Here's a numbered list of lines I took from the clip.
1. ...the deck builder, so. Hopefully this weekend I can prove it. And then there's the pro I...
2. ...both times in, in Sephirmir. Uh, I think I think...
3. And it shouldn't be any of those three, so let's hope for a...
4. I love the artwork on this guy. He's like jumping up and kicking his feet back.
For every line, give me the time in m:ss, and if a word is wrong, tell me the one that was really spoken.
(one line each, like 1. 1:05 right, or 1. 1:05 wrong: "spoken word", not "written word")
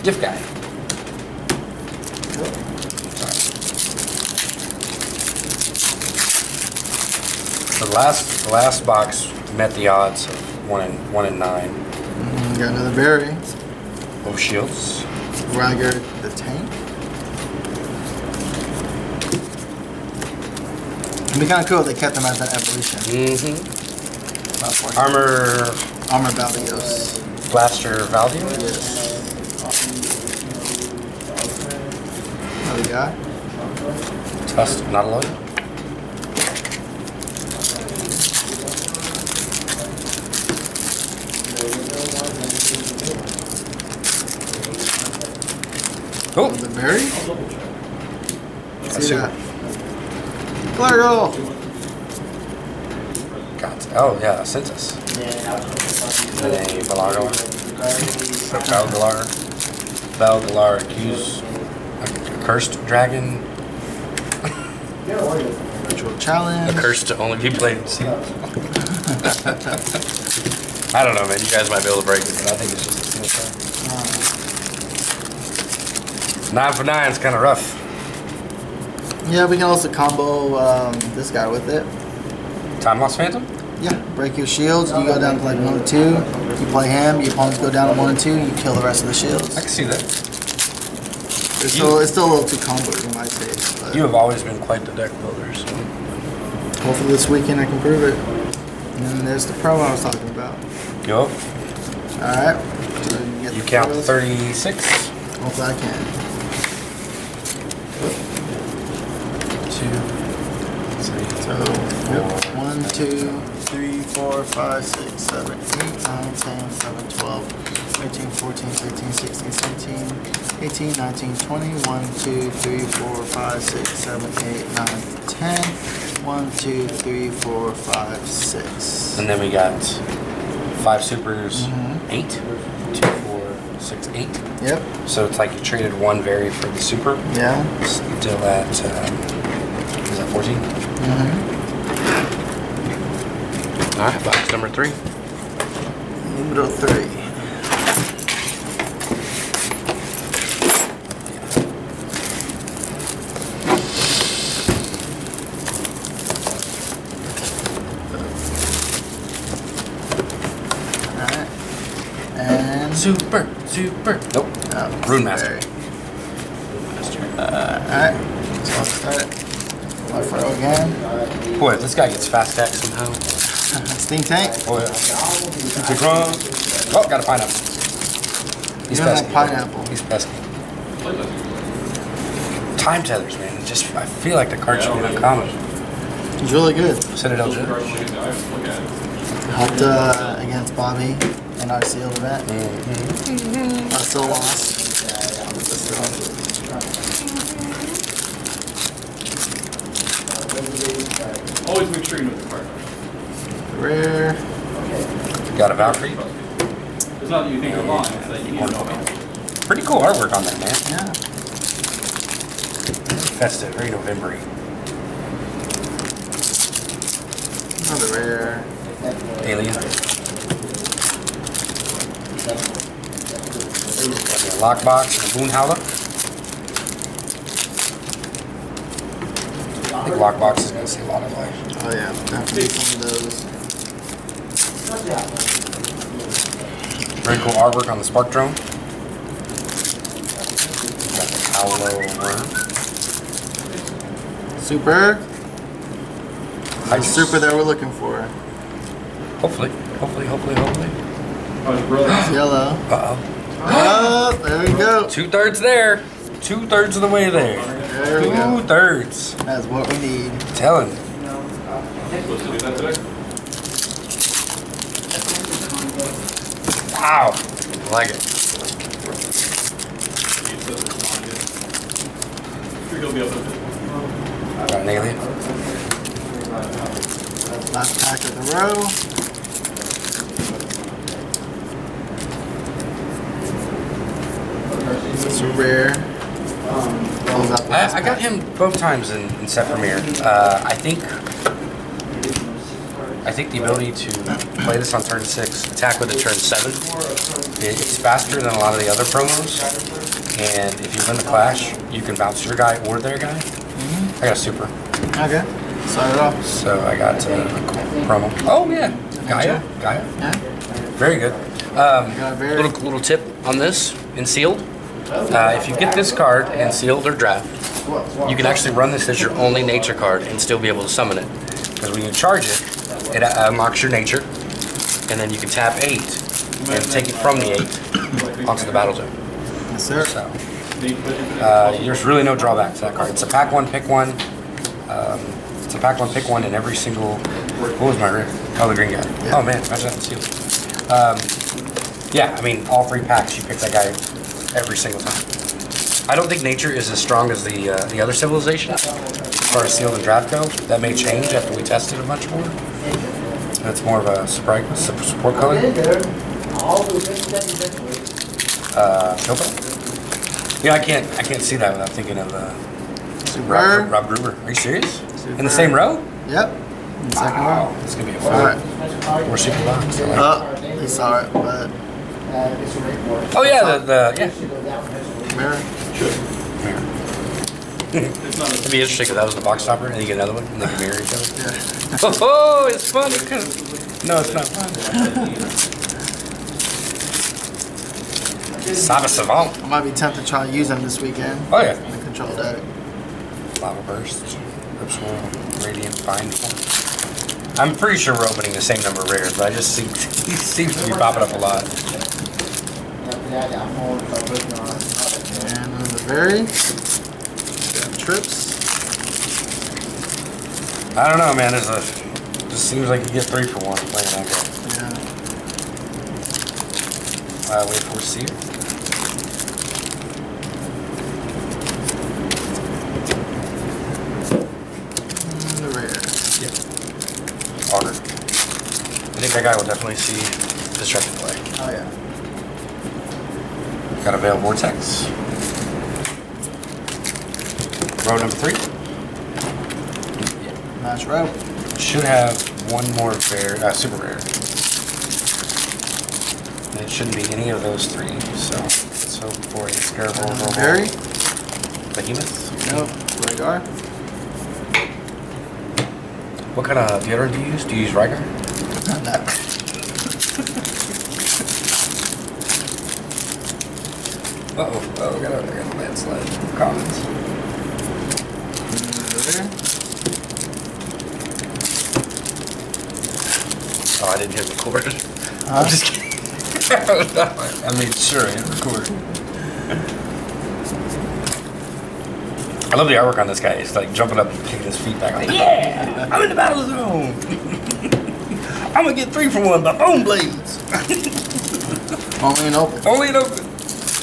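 1. 1:34 right
2. 4:48 right
3. 7:26 right
4. 8:02 right.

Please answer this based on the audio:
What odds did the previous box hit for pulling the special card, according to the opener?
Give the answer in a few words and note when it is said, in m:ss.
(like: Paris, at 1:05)
one in nine, at 0:11.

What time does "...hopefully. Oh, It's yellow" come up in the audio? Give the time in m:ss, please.
4:10.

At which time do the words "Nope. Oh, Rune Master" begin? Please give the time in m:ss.
2:44.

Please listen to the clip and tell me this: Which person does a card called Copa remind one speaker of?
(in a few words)
Rob Gruber.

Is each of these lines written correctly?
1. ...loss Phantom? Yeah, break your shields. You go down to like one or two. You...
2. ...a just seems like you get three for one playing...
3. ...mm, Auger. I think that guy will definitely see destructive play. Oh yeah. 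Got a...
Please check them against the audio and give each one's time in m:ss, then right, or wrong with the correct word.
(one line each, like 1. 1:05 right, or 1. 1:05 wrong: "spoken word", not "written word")
1. 1:23 right
2. 6:51 right
3. 7:05 right.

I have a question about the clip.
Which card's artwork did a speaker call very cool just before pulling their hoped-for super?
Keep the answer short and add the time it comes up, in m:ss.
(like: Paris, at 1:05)
spark drone, at 3:58.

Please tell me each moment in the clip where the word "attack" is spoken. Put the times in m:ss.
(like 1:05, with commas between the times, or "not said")
2:52, 4:55.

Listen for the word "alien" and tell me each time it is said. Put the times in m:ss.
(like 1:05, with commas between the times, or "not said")
3:39, 4:34.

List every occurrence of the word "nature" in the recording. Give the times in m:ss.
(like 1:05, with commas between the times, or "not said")
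5:19, 5:23, 5:46.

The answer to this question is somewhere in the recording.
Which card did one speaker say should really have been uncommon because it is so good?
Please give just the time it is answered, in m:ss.
3:02.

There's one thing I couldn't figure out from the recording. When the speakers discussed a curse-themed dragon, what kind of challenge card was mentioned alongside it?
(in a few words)
Ritual challenge.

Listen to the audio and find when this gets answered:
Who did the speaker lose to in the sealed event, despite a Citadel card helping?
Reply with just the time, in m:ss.
3:10.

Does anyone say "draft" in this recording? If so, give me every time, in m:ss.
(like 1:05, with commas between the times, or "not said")
5:17, 5:50.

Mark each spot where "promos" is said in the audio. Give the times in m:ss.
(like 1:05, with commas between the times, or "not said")
4:59, 5:08.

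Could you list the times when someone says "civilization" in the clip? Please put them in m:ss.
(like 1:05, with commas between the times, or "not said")
5:48.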